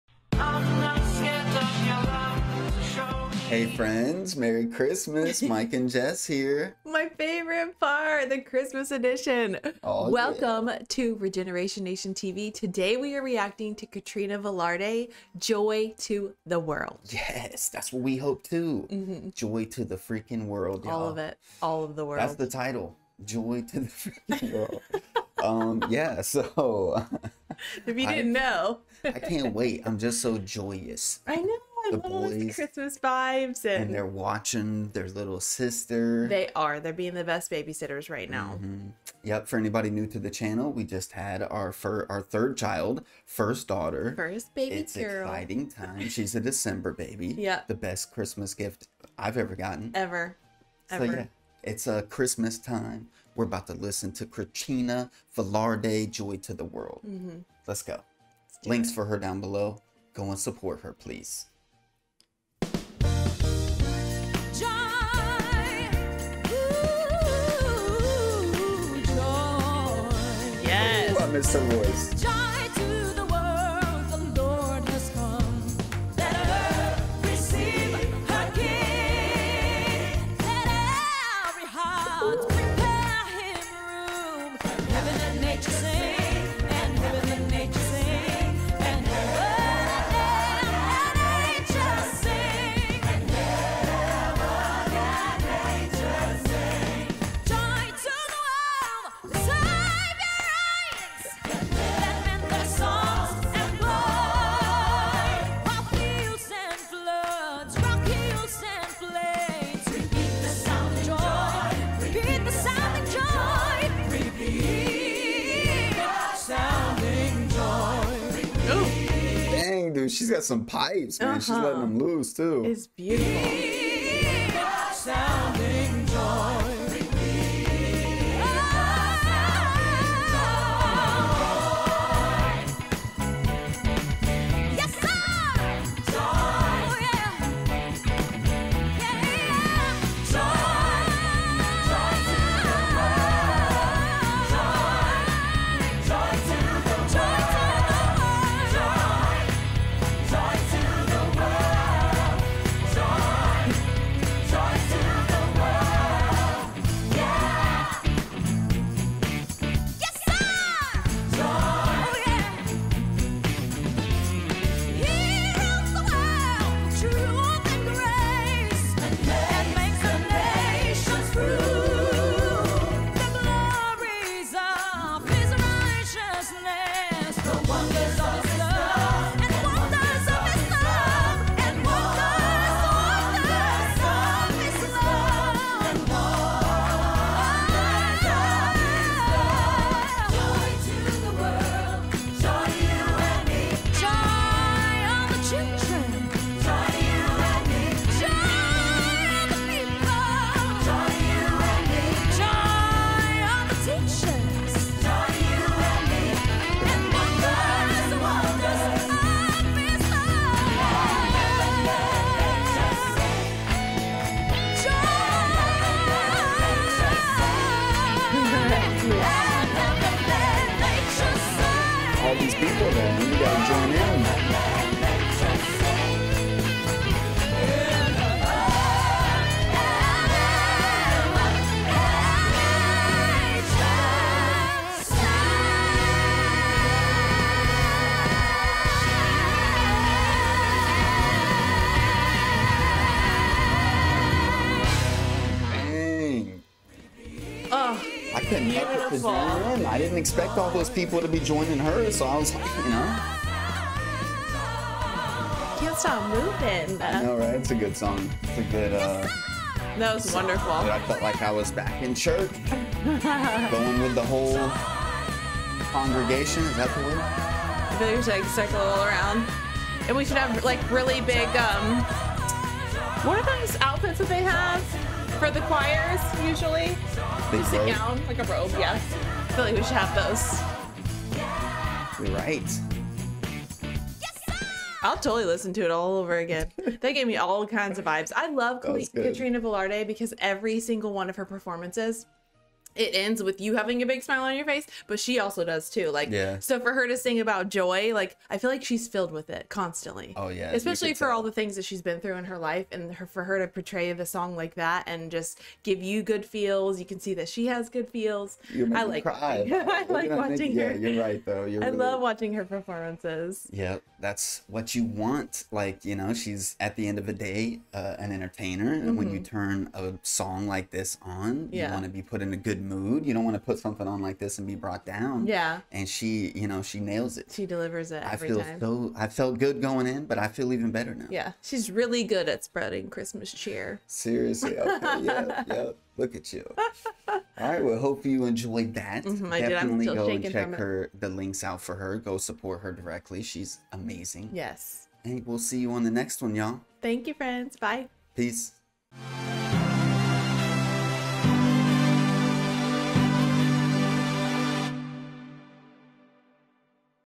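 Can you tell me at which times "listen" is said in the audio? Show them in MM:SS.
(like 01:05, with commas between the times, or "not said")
00:53, 04:45.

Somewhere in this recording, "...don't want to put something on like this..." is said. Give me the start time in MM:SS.
05:23.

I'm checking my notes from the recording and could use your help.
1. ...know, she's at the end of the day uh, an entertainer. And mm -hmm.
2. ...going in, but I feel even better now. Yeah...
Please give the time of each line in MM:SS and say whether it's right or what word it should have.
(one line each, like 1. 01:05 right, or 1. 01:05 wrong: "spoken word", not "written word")
1. 05:16 right
2. 05:29 right.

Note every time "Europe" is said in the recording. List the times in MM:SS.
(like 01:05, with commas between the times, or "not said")
not said.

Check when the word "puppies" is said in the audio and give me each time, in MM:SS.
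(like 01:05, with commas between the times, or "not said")
not said.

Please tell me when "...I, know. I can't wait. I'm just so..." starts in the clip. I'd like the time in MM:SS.
00:28.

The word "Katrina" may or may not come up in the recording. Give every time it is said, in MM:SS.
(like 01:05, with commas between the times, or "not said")
00:13, 04:48.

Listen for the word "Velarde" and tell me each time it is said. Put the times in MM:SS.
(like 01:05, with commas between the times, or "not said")
00:14, 00:55, 04:49.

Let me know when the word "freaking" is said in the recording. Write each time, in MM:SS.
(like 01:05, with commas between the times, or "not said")
00:19, 00:24.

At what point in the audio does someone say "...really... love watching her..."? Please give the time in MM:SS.
05:11.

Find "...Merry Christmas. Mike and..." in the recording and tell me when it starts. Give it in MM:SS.
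00:04.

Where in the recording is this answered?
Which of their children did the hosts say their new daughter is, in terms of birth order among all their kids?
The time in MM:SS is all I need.
00:42.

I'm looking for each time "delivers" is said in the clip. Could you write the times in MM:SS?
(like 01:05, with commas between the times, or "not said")
05:27.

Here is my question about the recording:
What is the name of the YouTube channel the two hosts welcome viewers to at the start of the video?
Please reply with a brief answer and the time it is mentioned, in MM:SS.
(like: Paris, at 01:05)
Regeneration Nation TV, at 00:11.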